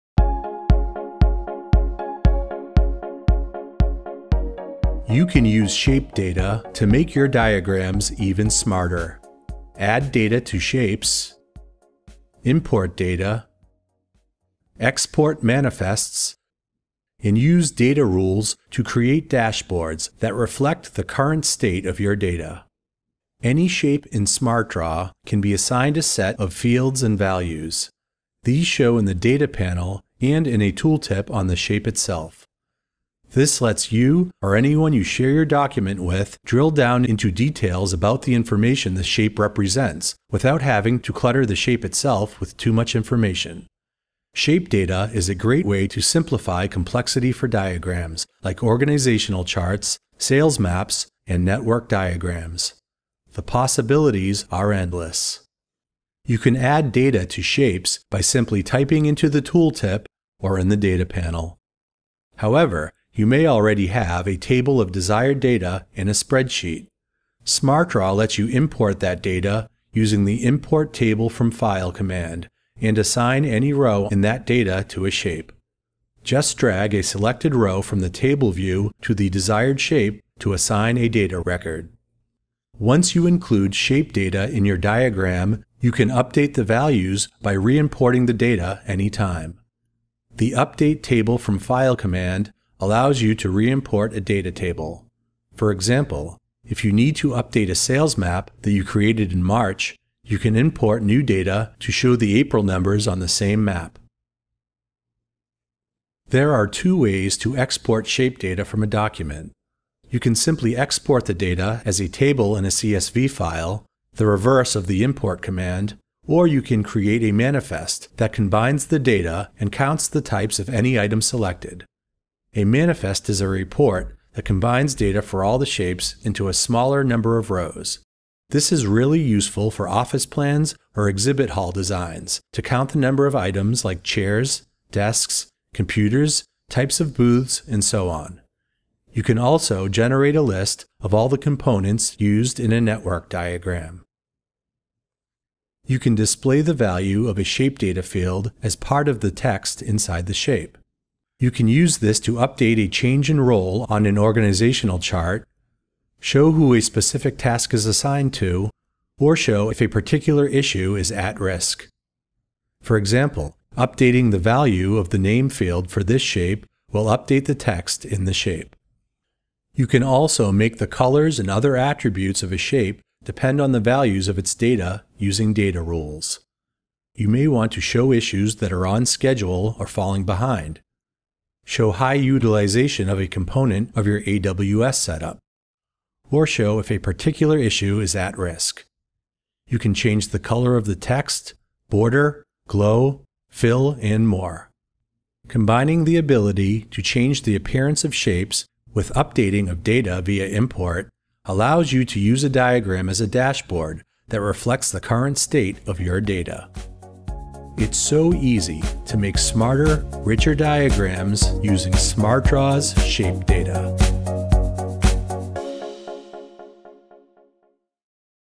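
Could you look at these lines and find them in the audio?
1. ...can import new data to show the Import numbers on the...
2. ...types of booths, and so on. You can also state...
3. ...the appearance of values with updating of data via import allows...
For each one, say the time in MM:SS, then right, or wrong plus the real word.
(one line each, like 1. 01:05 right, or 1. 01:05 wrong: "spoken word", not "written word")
1. 01:40 wrong: "April", not "Import"
2. 02:16 wrong: "generate", not "state"
3. 03:17 wrong: "shapes", not "values".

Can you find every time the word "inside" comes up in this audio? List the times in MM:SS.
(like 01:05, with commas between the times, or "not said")
02:29.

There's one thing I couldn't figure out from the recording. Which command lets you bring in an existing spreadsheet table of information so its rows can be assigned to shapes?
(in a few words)
Import Table from File.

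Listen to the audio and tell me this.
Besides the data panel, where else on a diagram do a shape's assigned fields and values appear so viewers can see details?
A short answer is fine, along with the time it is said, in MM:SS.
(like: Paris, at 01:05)
A tooltip, at 00:30.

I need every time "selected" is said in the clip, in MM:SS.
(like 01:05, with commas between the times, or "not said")
01:17, 02:01.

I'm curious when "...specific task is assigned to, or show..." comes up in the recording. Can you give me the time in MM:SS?
02:36.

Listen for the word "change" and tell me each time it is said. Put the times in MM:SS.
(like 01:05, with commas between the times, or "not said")
02:32, 03:09, 03:17.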